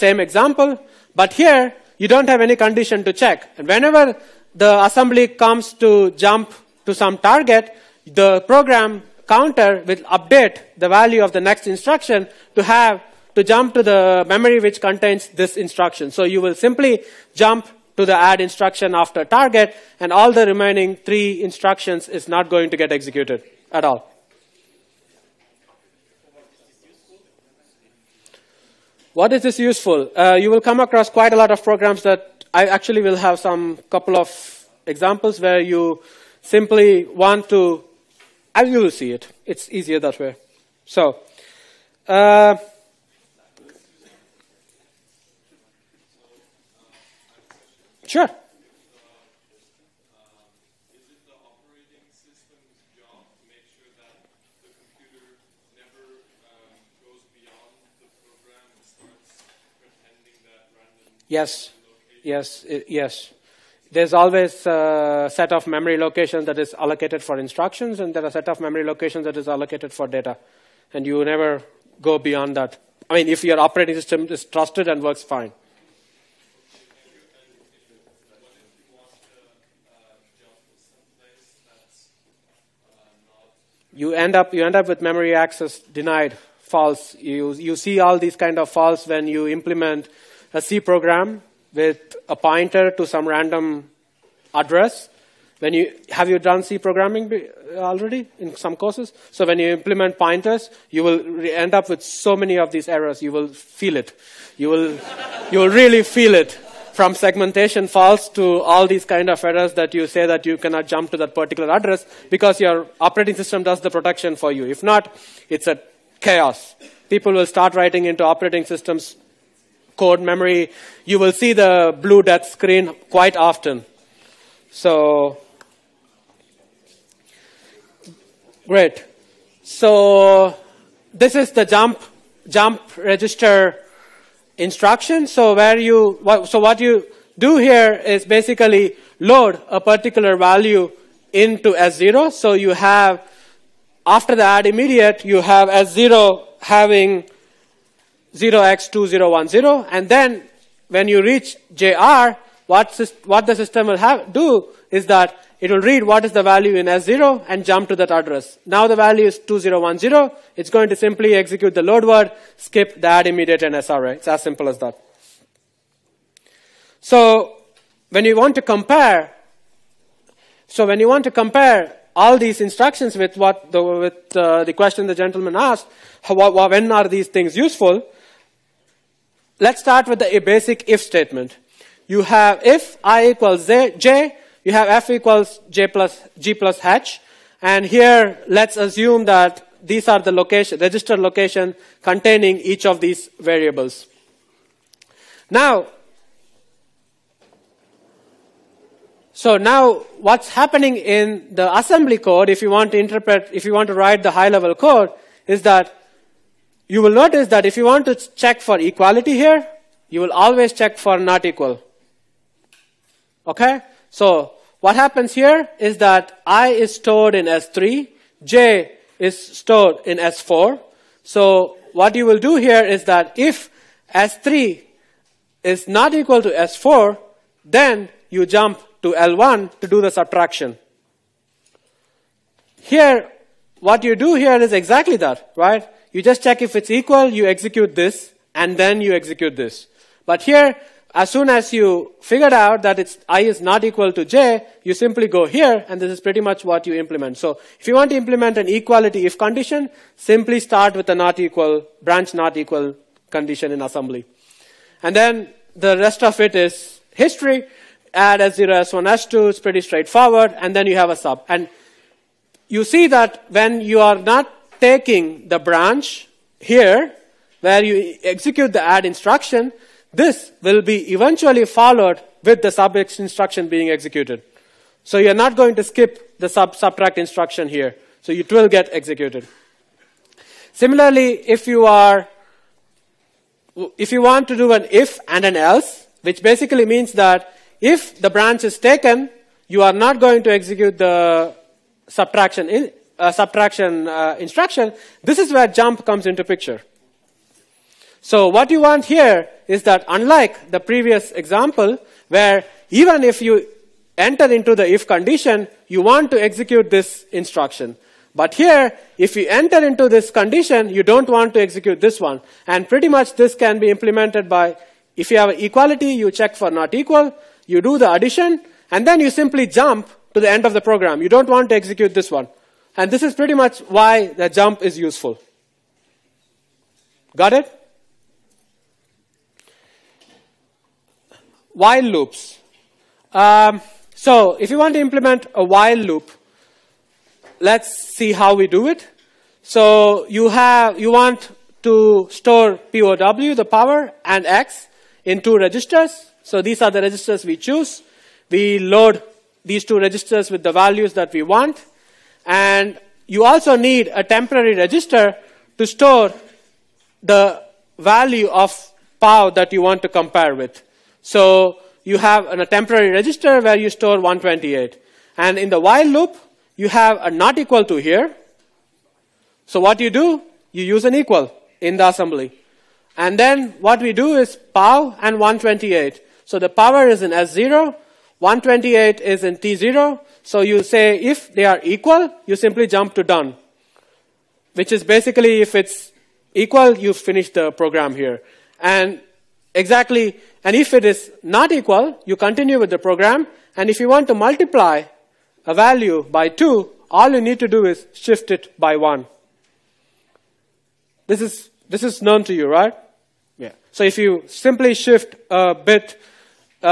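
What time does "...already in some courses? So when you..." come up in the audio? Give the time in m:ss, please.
1:37.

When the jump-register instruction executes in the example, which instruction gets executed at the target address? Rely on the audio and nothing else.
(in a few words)
load word.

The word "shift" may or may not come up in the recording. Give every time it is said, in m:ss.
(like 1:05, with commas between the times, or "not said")
6:38, 6:44.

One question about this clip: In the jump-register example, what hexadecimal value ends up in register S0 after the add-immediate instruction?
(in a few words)
0x2010.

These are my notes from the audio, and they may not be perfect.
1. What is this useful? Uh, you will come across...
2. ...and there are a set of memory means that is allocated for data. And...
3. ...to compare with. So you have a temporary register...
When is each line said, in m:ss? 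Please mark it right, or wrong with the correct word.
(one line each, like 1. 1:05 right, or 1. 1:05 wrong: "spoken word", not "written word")
1. 0:29 right
2. 1:08 wrong: "locations", not "means"
3. 6:00 right.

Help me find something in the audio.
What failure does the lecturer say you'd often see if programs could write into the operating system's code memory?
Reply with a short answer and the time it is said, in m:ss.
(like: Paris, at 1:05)
blue death screen, at 2:02.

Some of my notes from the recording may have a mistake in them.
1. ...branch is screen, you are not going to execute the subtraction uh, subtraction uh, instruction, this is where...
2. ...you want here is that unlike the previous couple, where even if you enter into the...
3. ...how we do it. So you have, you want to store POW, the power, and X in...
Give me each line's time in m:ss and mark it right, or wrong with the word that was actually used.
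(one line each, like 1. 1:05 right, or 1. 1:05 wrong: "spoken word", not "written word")
1. 4:48 wrong: "taken", not "screen"
2. 4:58 wrong: "example", not "couple"
3. 5:38 right.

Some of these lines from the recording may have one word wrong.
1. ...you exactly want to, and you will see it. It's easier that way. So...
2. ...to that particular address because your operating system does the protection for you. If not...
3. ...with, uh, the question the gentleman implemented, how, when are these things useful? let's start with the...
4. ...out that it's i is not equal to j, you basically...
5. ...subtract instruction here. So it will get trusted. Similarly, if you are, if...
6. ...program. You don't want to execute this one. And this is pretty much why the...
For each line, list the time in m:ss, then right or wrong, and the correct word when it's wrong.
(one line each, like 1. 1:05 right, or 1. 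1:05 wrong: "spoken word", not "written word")
1. 0:35 wrong: "simply", not "exactly"
2. 1:51 right
3. 2:53 wrong: "asked", not "implemented"
4. 4:02 wrong: "simply", not "basically"
5. 4:36 wrong: "executed", not "trusted"
6. 5:20 right.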